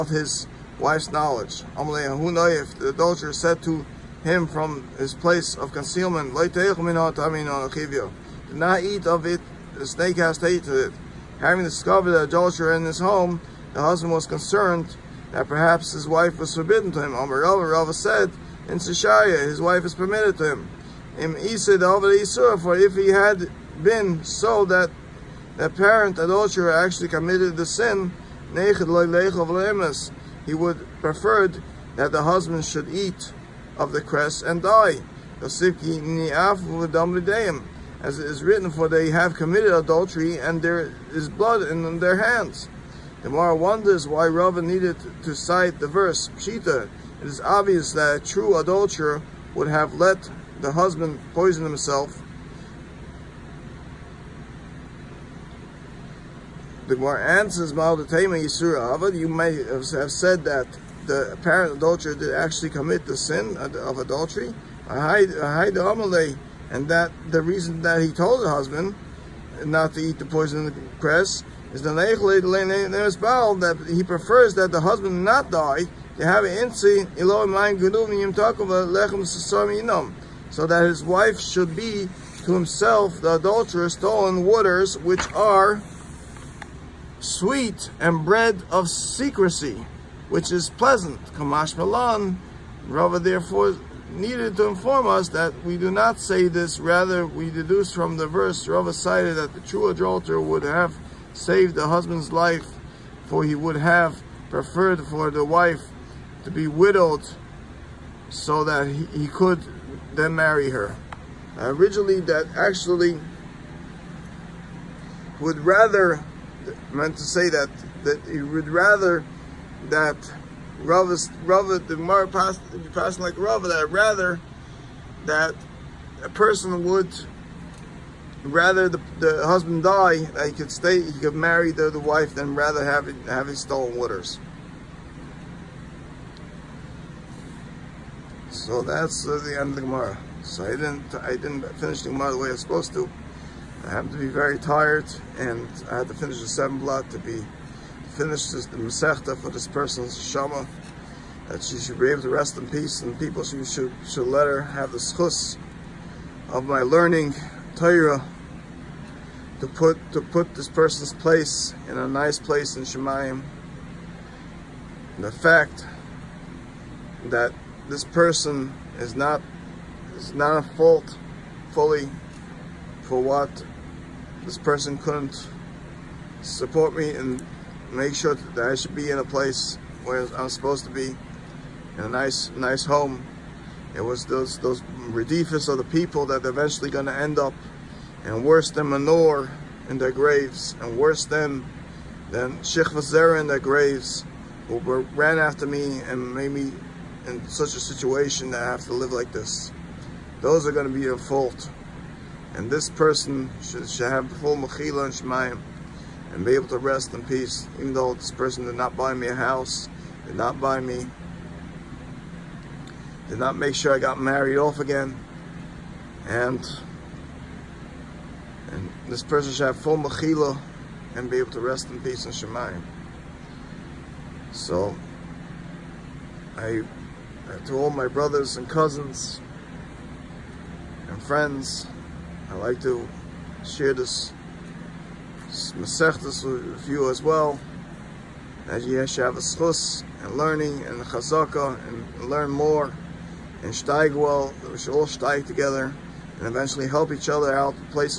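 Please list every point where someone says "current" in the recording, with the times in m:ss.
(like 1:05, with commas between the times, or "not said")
not said.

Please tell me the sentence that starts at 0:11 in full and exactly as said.
Having discovered the adulterer in his home, the husband was concerned that perhaps his wife was forbidden to him.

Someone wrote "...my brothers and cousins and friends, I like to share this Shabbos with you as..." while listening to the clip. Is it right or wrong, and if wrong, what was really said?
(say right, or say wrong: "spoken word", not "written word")
wrong: "Masechtas", not "Shabbos".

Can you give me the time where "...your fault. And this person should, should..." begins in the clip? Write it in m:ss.
3:21.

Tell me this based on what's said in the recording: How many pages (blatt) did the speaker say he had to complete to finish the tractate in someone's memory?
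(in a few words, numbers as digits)
7.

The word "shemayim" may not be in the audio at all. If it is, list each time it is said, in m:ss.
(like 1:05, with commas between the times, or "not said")
2:42, 3:25, 3:42.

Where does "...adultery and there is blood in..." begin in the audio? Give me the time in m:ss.
0:39.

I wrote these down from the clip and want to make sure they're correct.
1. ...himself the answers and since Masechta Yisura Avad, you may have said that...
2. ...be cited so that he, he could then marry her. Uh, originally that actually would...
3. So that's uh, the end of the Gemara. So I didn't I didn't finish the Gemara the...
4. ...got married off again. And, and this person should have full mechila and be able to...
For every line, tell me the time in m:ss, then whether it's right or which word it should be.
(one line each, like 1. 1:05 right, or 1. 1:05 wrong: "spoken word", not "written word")
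1. 0:51 wrong: "Maldatema", not "Masechta"
2. 1:46 wrong: "widowed", not "cited"
3. 2:18 right
4. 3:33 right.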